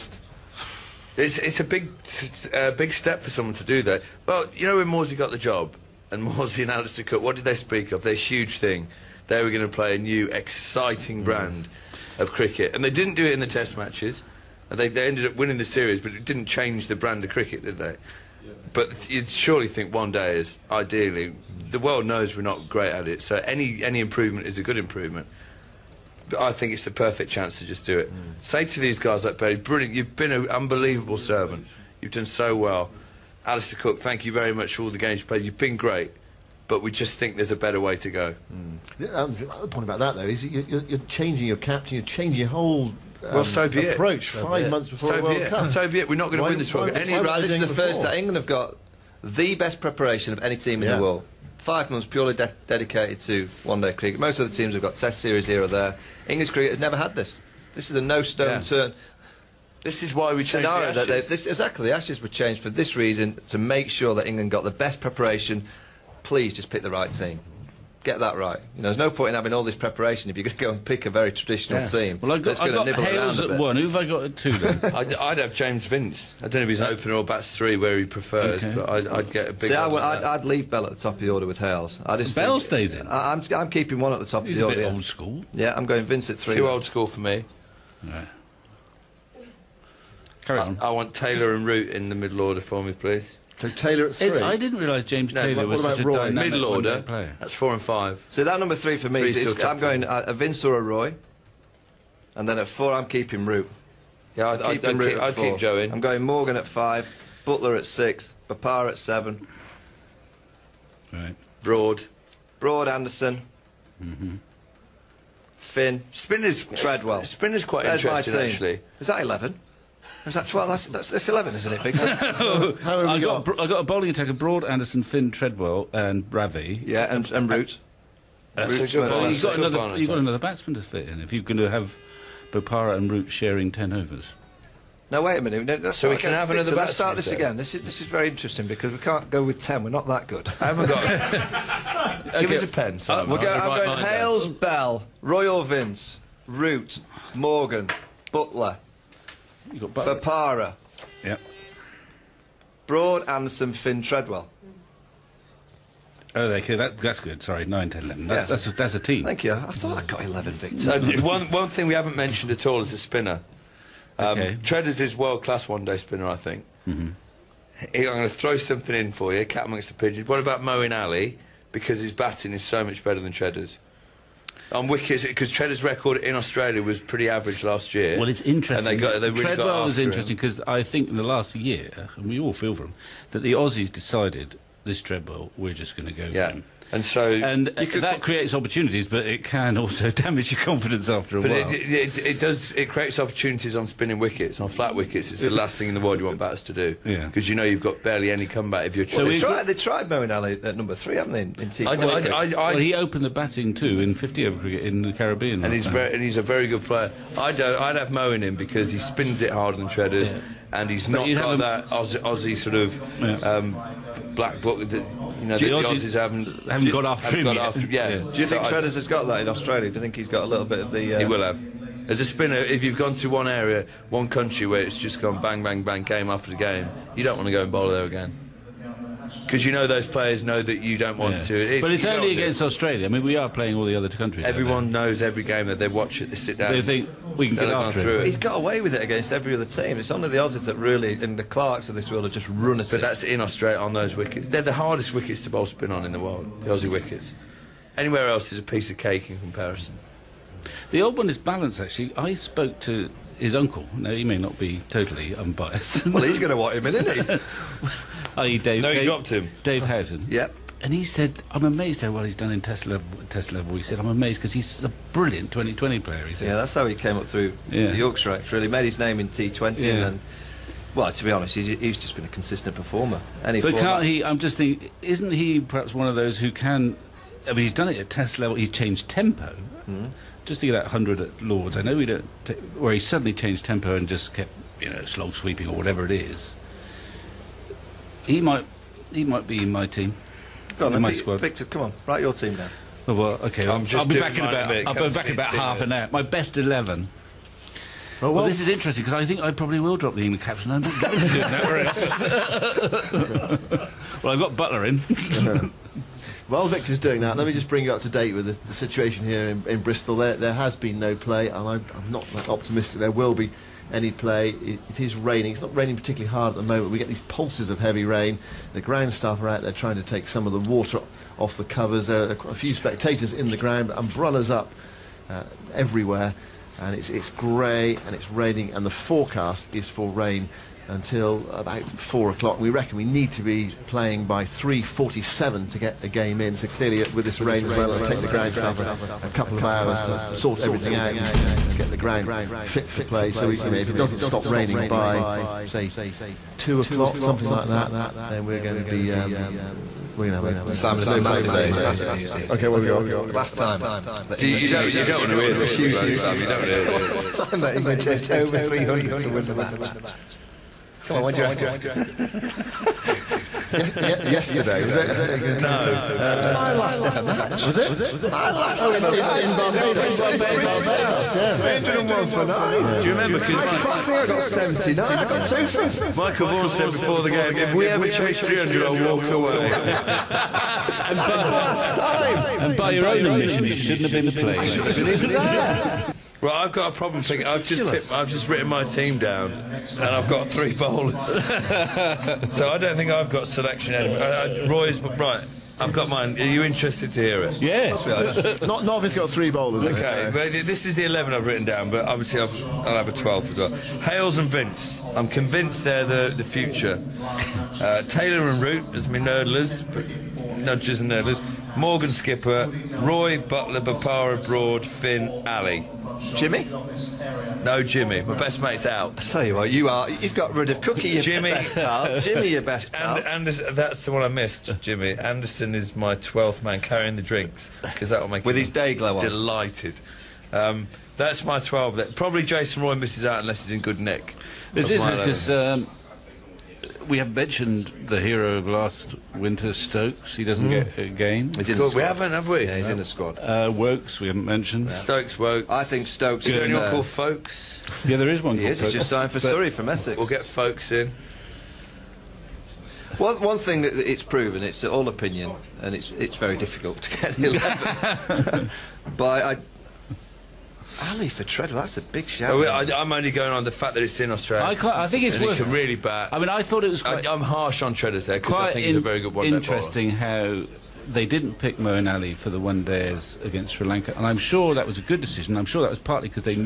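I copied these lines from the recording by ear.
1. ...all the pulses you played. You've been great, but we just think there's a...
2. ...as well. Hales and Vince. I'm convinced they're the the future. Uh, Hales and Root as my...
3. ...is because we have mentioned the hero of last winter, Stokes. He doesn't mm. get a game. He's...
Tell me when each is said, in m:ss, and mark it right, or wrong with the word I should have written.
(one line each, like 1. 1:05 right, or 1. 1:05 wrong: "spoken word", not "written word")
1. 0:34 wrong: "games", not "pulses"
2. 6:43 wrong: "Taylor", not "Hales"
3. 7:14 right.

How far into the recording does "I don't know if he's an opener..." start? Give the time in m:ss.
1:16.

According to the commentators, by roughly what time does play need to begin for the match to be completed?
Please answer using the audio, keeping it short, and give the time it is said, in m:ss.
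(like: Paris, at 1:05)
3:47, at 5:34.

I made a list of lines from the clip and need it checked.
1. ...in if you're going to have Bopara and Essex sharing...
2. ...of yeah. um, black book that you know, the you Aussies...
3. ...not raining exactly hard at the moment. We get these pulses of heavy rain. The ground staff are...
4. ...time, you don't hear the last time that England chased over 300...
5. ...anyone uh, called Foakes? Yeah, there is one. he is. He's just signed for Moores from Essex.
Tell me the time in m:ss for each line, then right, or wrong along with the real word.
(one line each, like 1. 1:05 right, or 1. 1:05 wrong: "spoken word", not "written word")
1. 2:11 wrong: "Root", not "Essex"
2. 3:32 right
3. 5:15 wrong: "particularly", not "exactly"
4. 5:56 right
5. 7:26 wrong: "Surrey", not "Moores".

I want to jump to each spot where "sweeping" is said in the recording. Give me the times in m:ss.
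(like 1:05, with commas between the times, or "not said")
4:45.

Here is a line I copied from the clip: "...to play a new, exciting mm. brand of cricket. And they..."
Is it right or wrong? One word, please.
right.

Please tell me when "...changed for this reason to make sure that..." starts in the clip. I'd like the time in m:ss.
1:02.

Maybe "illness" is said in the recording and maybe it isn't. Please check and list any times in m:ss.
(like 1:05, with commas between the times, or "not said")
not said.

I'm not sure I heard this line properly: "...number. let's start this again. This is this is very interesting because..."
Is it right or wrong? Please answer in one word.
wrong.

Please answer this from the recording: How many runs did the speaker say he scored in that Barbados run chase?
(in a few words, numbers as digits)
79.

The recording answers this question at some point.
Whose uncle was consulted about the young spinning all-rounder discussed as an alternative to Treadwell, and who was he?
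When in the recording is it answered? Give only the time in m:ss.
4:19.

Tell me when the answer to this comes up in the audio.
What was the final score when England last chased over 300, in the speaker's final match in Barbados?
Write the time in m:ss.
6:11.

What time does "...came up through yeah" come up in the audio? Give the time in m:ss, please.
4:26.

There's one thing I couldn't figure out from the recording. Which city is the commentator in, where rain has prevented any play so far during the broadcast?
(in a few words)
Bristol.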